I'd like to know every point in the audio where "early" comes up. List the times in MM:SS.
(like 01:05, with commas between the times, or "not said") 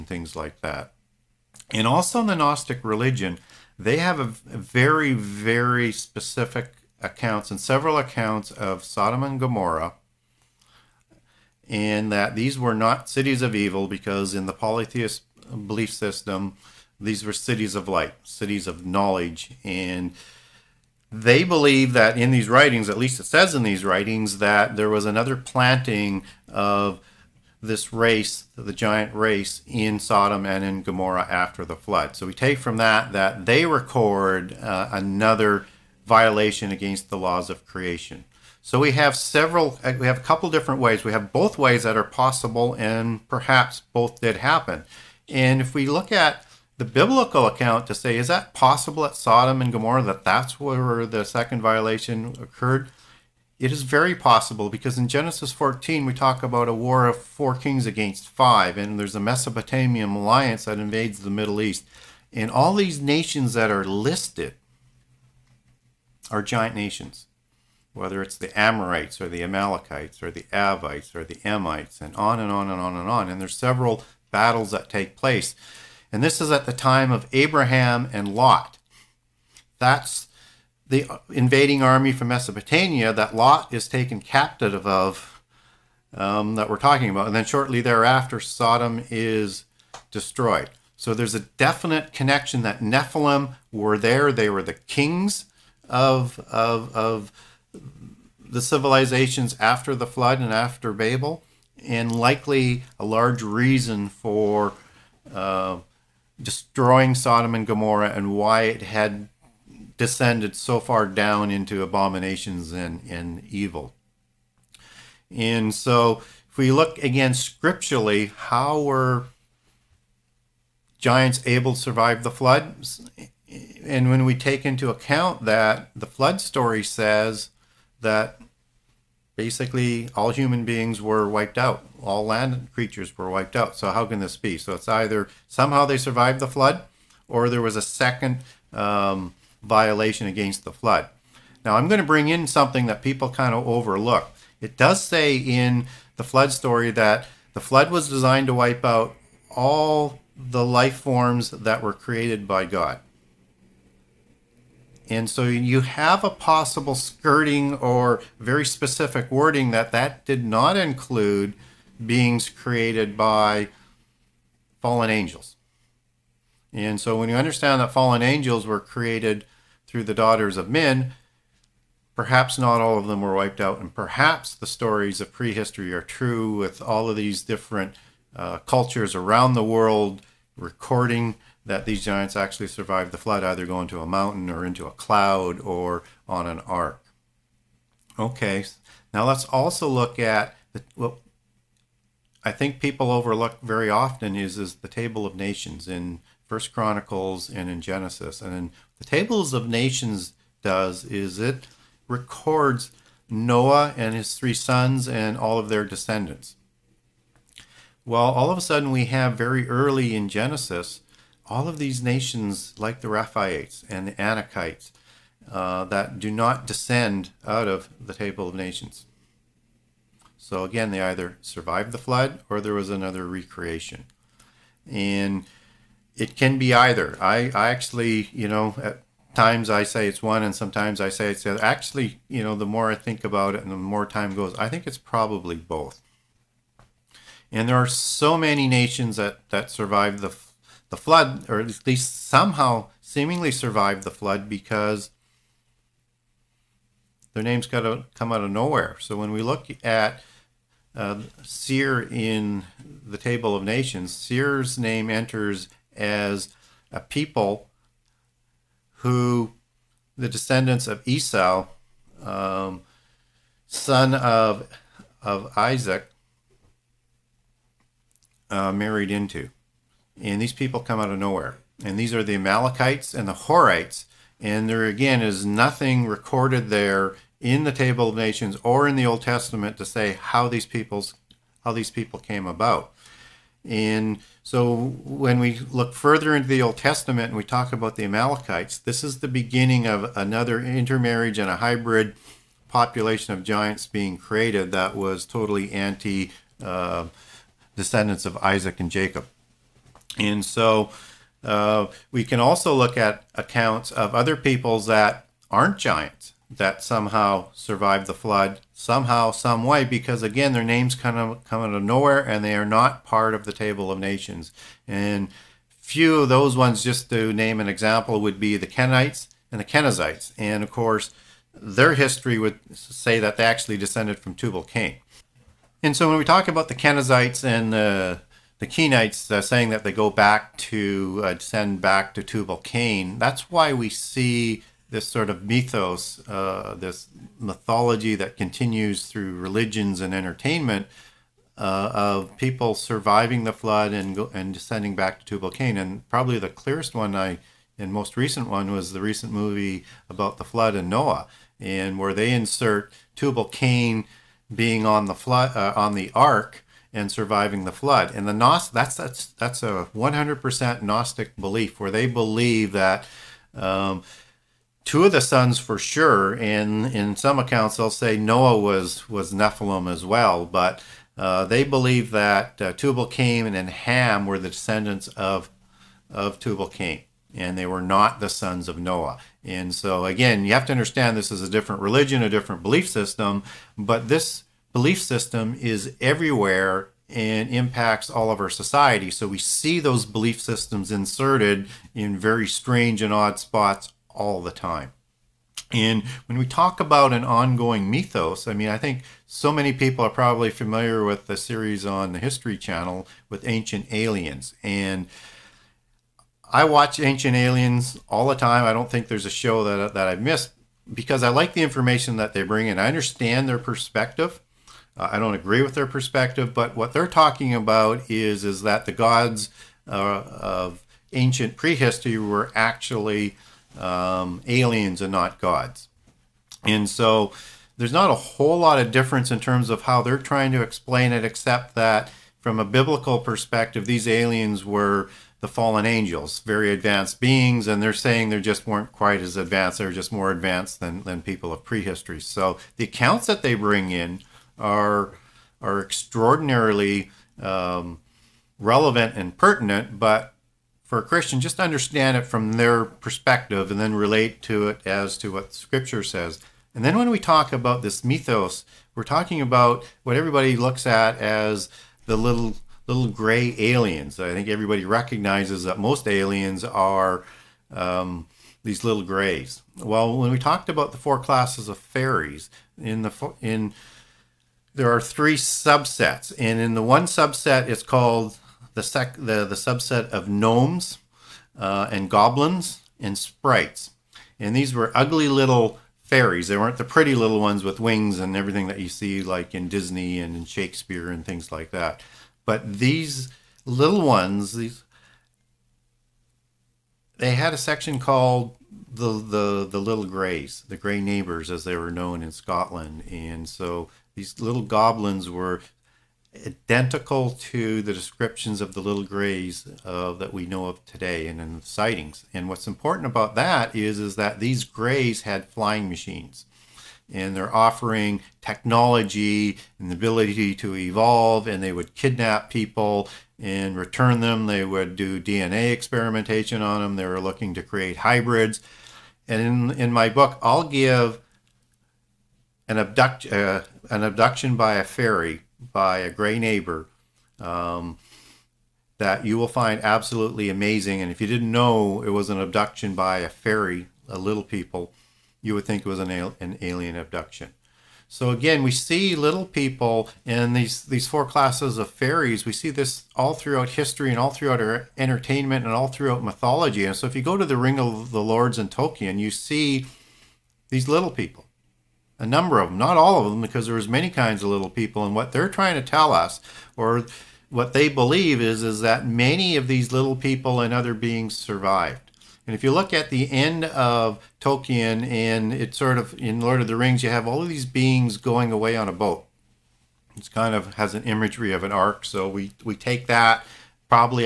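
03:29.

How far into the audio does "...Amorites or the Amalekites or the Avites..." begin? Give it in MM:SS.
01:08.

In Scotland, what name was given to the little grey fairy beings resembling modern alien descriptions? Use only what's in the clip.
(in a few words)
grey neighbors.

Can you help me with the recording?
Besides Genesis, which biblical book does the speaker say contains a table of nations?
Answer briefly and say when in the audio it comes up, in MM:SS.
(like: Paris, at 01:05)
First Chronicles, at 03:16.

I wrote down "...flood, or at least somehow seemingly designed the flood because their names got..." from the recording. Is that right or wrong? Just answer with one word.
wrong.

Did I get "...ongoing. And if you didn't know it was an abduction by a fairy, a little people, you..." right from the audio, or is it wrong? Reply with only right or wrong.
wrong.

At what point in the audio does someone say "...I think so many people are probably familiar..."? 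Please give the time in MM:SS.
06:38.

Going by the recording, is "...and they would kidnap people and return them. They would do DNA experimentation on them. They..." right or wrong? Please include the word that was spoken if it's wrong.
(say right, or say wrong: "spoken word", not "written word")
right.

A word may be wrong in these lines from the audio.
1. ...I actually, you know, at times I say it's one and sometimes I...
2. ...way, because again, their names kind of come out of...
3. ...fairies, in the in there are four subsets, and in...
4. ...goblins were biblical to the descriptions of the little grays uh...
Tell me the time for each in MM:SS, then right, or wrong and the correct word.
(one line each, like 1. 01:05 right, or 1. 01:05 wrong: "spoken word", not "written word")
1. 03:47 right
2. 05:09 right
3. 07:51 wrong: "three", not "four"
4. 08:24 wrong: "identical", not "biblical".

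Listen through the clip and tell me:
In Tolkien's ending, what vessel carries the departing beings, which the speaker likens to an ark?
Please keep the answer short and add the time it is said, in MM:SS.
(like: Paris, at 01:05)
a boat, at 09:38.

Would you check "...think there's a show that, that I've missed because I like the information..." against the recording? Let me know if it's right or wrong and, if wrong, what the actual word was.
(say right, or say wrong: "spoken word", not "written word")
right.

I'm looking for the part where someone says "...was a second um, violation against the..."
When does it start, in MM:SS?
02:17.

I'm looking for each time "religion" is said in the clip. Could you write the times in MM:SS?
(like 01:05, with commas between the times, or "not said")
00:02, 05:39, 06:21.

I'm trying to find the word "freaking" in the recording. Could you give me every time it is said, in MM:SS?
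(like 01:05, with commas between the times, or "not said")
not said.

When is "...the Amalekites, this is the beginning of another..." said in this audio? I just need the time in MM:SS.
04:47.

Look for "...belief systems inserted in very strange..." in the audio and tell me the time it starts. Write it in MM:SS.
06:30.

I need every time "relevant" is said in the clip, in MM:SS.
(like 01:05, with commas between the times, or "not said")
07:28.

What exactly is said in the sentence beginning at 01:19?
That's the invading army from Mesopotamia that Lot is taken captive of, um, that we're talking about.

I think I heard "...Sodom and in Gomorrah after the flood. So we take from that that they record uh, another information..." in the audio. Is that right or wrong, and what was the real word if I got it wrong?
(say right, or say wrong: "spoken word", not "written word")
wrong: "violation", not "information".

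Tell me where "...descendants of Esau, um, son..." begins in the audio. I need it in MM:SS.
04:20.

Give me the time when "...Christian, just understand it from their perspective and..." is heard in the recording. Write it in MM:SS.
07:31.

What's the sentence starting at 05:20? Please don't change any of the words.
And of course, their history would say that they actually descended from Tubal-Cain.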